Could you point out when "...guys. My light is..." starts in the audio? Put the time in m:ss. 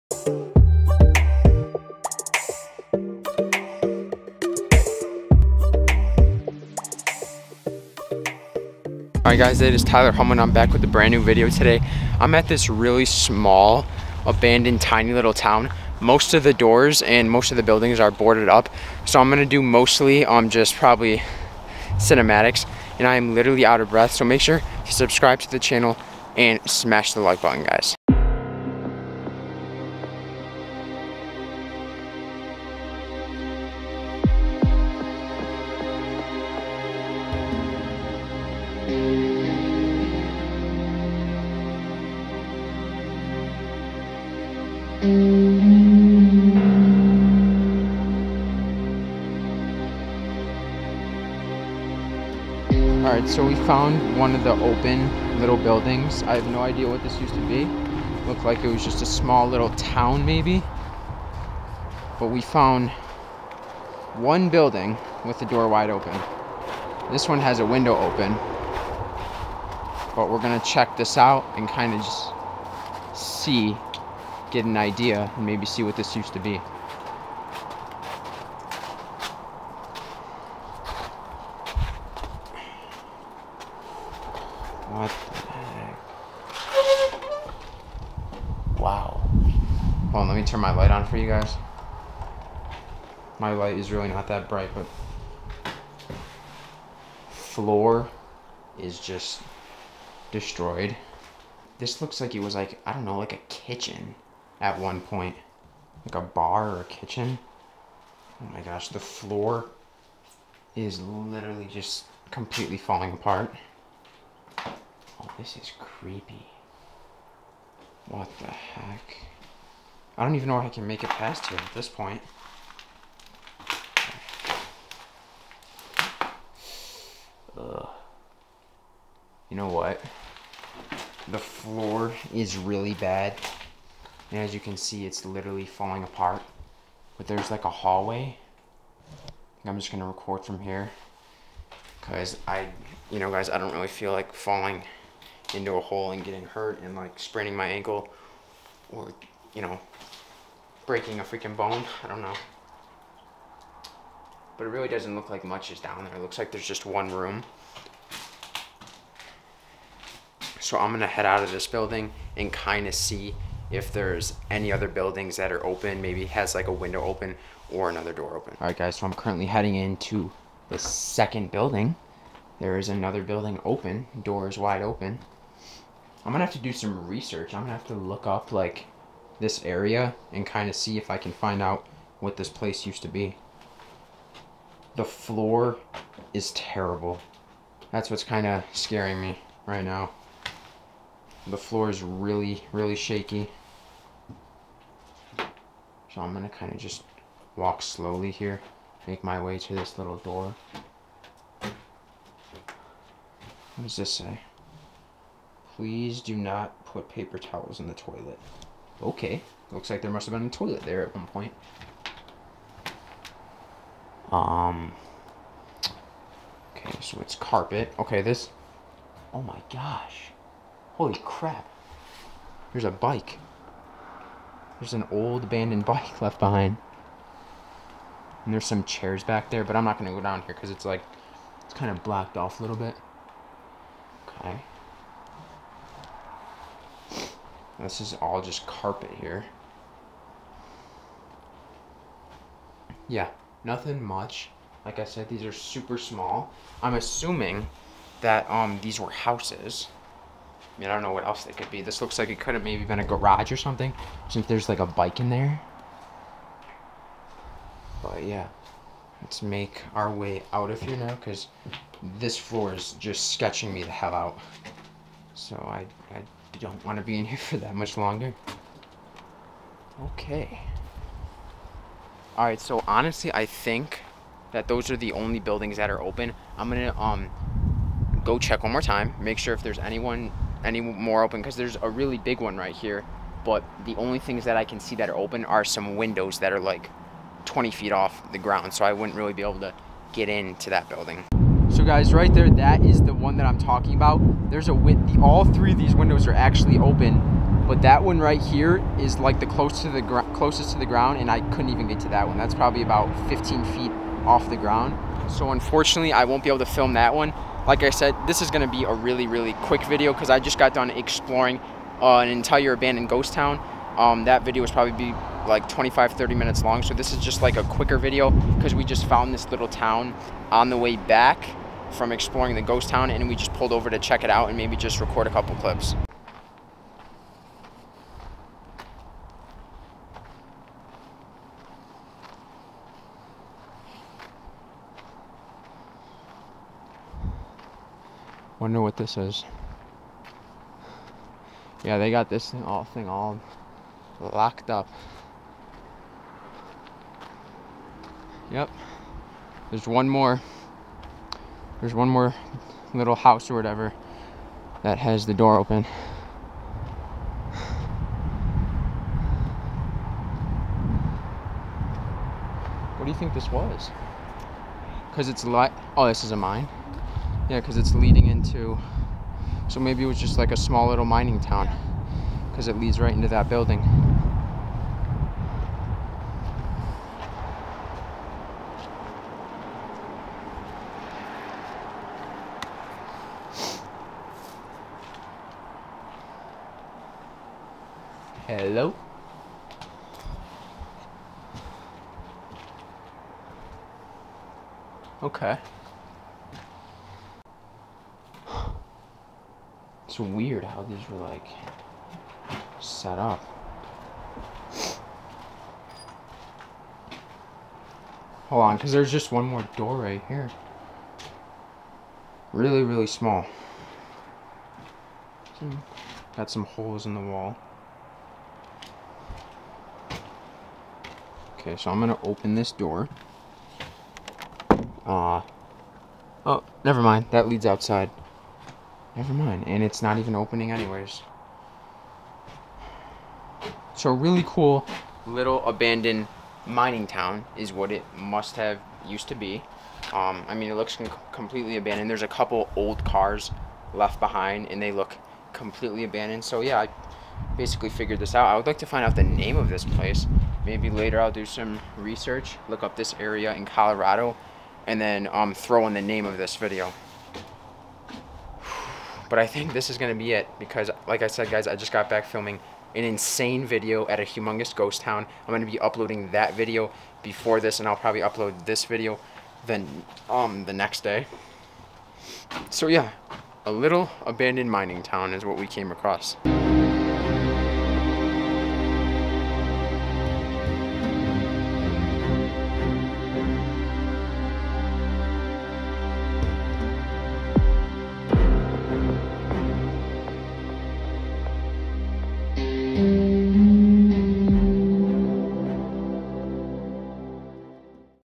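1:31.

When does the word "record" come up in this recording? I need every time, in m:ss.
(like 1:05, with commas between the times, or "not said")
2:20, 5:24.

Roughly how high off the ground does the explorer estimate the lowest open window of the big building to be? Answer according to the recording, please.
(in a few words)
15 feet.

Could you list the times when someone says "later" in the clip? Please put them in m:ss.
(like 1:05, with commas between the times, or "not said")
7:30.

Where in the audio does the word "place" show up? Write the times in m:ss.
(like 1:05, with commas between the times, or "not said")
3:02, 7:29.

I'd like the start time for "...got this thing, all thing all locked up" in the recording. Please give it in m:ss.
5:42.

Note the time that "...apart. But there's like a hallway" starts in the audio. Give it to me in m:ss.
2:16.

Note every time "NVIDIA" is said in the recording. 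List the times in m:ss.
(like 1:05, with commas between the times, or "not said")
not said.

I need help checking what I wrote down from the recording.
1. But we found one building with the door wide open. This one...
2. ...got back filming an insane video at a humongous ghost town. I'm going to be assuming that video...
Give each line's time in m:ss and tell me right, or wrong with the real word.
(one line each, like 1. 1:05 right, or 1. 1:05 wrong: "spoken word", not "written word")
1. 1:02 right
2. 7:41 wrong: "uploading", not "assuming".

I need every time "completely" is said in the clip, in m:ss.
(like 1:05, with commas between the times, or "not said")
1:52, 7:21, 7:25.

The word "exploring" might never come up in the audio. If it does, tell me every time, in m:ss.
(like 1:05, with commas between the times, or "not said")
5:10, 5:22.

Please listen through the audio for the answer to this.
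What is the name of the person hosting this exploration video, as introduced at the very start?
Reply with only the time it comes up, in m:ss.
0:09.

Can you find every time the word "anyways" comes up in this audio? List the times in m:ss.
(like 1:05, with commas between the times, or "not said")
7:10.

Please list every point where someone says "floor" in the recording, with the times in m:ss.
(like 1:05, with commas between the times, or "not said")
1:37, 1:48, 2:11, 3:05, 3:11, 4:22.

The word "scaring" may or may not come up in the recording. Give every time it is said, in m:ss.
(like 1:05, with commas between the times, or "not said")
3:08.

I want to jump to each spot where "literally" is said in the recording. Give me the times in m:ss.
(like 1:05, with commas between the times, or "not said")
0:23, 1:51, 2:15.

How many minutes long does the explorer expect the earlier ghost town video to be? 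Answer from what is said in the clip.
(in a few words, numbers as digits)
25-30 minutes.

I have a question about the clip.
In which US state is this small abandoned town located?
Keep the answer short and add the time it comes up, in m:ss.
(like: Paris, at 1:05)
Colorado, at 7:33.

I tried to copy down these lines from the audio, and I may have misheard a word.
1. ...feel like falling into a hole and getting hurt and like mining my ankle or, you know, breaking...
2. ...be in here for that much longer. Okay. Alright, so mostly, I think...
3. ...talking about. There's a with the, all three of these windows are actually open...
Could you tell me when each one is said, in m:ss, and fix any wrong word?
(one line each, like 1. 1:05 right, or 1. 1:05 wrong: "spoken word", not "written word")
1. 2:23 wrong: "spraining", not "mining"
2. 4:27 wrong: "honestly", not "mostly"
3. 4:53 right.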